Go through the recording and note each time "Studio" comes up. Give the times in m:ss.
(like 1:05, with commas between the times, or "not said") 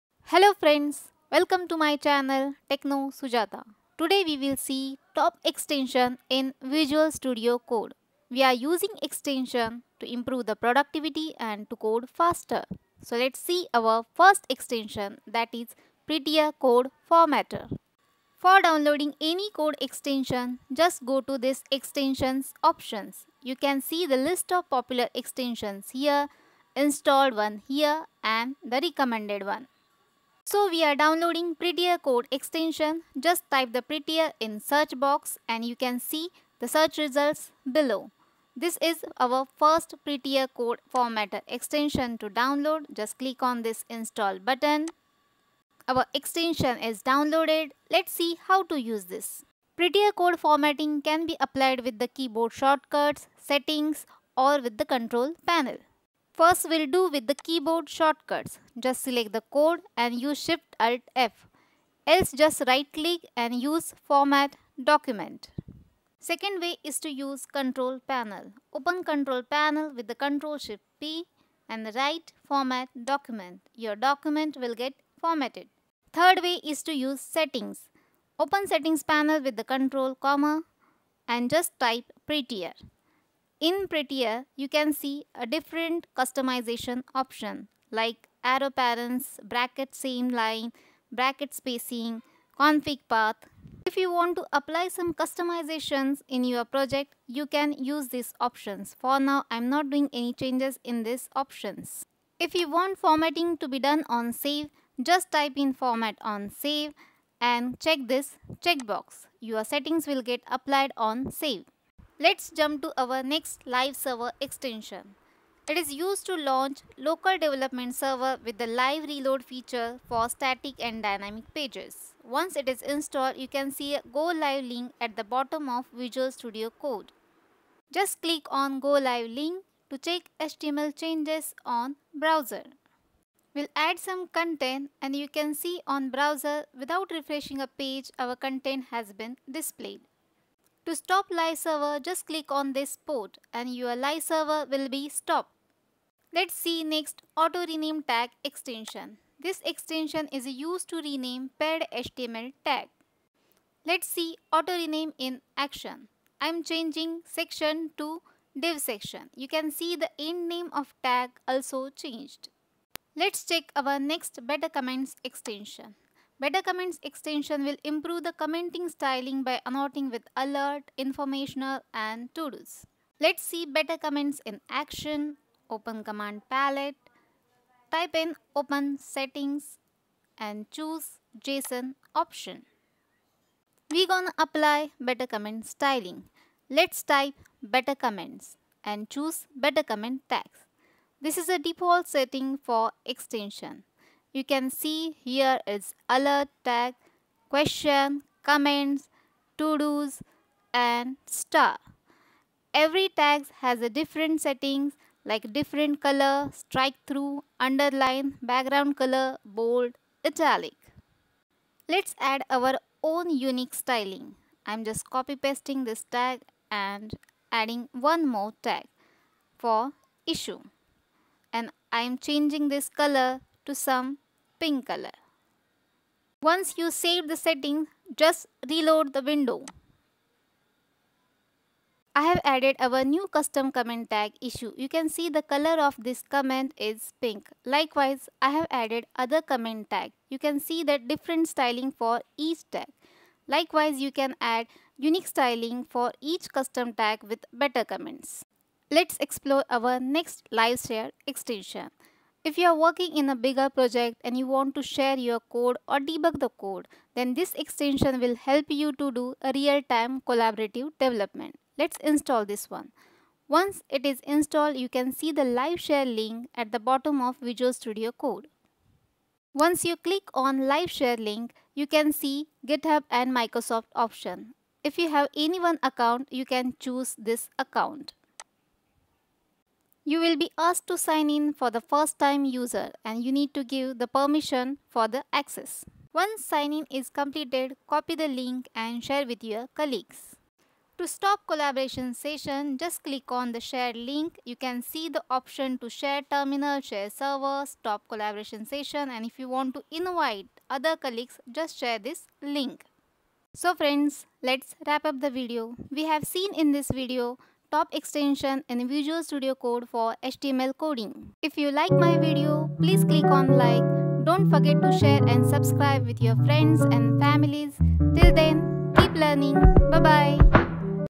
0:07, 2:06, 4:27, 5:09.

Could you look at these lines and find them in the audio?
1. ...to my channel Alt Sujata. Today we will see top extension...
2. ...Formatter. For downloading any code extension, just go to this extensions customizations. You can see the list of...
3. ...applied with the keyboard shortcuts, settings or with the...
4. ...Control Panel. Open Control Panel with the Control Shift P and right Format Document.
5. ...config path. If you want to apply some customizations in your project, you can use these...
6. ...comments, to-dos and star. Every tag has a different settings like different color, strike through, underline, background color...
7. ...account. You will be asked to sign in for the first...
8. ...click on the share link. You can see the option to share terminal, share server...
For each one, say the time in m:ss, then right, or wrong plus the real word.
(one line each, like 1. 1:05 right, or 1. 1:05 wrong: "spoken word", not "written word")
1. 0:01 wrong: "Techno", not "Alt"
2. 0:17 wrong: "options", not "customizations"
3. 0:51 right
4. 1:07 right
5. 1:32 right
6. 3:18 right
7. 4:37 right
8. 4:53 right.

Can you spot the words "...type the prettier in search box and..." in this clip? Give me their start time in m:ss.
0:33.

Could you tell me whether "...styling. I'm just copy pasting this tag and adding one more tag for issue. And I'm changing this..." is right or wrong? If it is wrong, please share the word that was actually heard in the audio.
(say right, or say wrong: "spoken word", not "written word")
right.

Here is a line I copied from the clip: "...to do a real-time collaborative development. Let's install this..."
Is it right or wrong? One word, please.
right.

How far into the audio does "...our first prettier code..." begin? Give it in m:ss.
0:39.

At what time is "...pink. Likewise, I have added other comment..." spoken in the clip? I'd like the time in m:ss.
3:57.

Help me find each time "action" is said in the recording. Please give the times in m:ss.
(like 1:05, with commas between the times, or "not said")
2:35, 2:54.